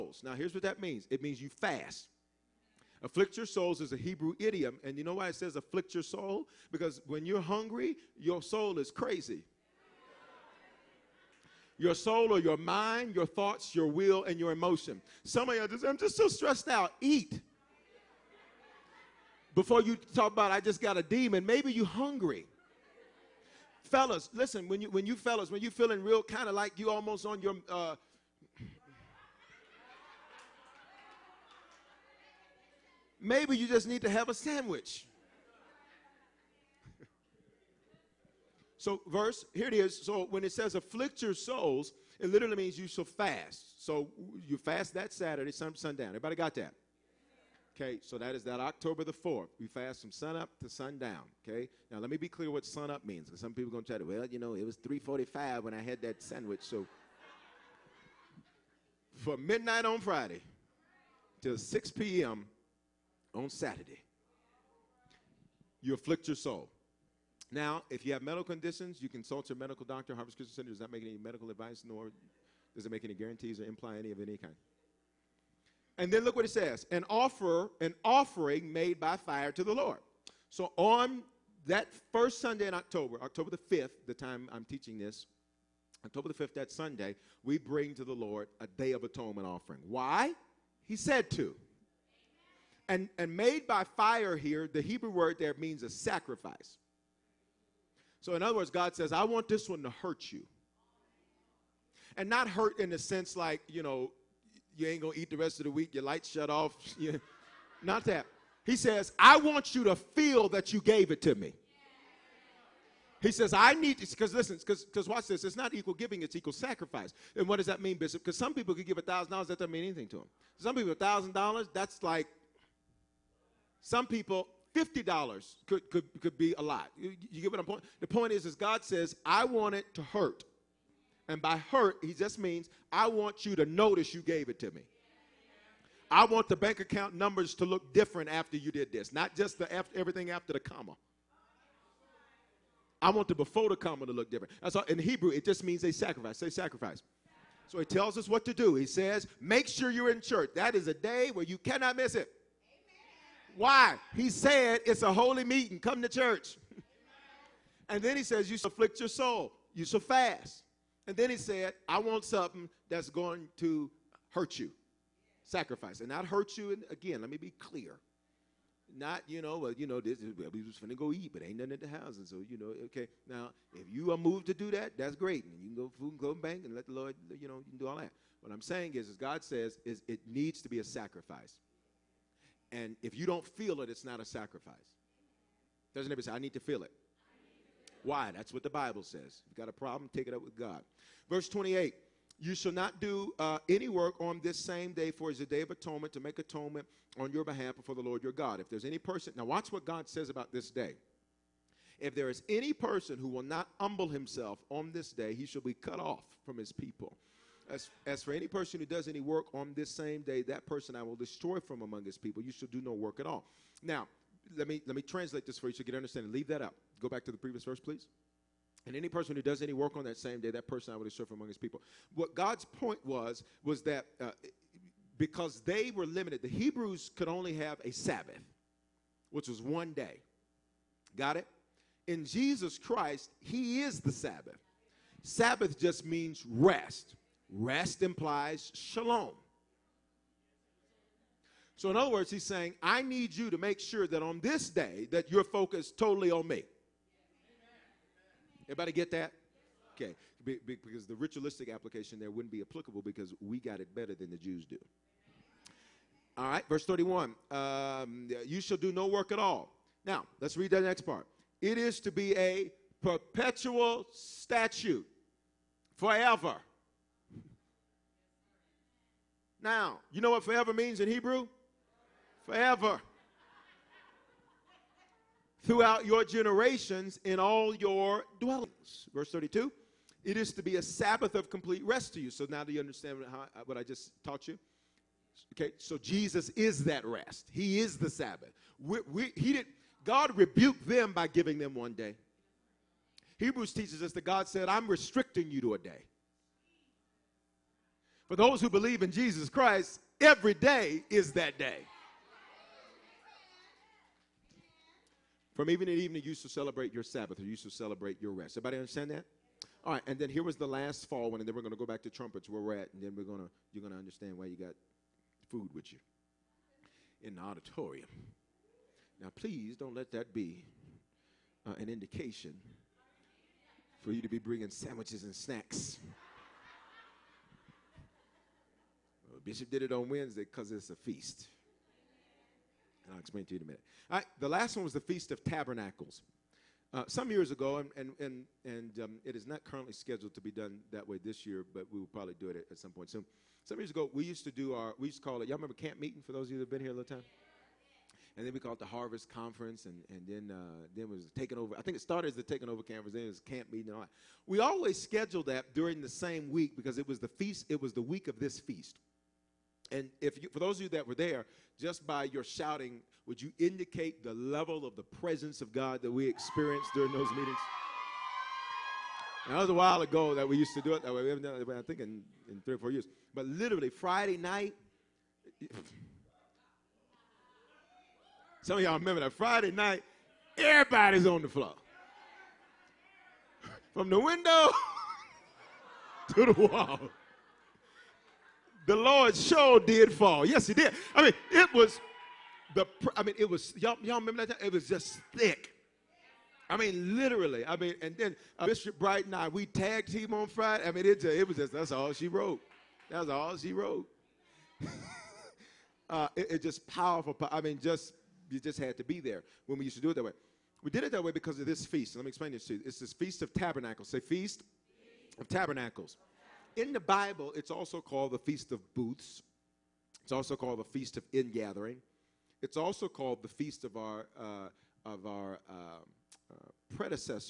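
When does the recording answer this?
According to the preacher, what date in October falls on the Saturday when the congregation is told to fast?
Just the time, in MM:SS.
00:48.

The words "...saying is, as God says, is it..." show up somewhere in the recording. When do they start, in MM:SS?
02:58.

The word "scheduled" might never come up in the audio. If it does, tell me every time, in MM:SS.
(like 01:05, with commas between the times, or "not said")
05:39, 05:55.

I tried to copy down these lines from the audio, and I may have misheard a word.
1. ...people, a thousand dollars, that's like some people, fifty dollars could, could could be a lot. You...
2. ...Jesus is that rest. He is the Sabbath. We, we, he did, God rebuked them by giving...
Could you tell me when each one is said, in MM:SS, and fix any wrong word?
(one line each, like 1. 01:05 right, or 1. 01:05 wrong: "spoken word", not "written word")
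1. 02:00 right
2. 04:45 right.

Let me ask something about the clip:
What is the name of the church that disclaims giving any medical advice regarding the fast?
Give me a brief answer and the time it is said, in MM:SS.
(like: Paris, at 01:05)
Harvest Christian Center, at 01:10.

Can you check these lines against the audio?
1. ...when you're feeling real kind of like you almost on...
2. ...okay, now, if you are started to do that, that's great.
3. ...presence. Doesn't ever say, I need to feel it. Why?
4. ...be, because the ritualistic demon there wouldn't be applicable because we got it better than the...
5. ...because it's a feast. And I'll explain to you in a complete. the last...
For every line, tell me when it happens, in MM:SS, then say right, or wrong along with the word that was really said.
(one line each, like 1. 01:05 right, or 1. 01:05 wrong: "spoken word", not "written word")
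1. 00:25 right
2. 02:52 wrong: "moved", not "started"
3. 03:04 wrong: "sacrifice", not "presence"
4. 04:10 wrong: "application", not "demon"
5. 05:30 wrong: "minute", not "complete".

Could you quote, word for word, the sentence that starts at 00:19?
Before you talk about, I just got a demon, maybe you're hungry.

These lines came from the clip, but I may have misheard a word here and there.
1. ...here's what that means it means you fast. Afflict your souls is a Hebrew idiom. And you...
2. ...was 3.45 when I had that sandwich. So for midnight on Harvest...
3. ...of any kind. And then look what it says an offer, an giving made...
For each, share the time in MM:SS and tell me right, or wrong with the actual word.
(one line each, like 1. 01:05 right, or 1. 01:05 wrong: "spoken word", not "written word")
1. 00:00 right
2. 00:54 wrong: "Friday", not "Harvest"
3. 01:14 wrong: "offering", not "giving".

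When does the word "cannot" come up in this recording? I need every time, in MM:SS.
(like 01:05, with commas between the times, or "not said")
02:31.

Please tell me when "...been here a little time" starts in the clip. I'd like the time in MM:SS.
05:46.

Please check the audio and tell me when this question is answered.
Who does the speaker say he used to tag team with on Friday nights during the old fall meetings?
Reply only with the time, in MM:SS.
06:38.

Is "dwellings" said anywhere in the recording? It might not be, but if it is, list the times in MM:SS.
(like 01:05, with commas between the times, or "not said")
04:38.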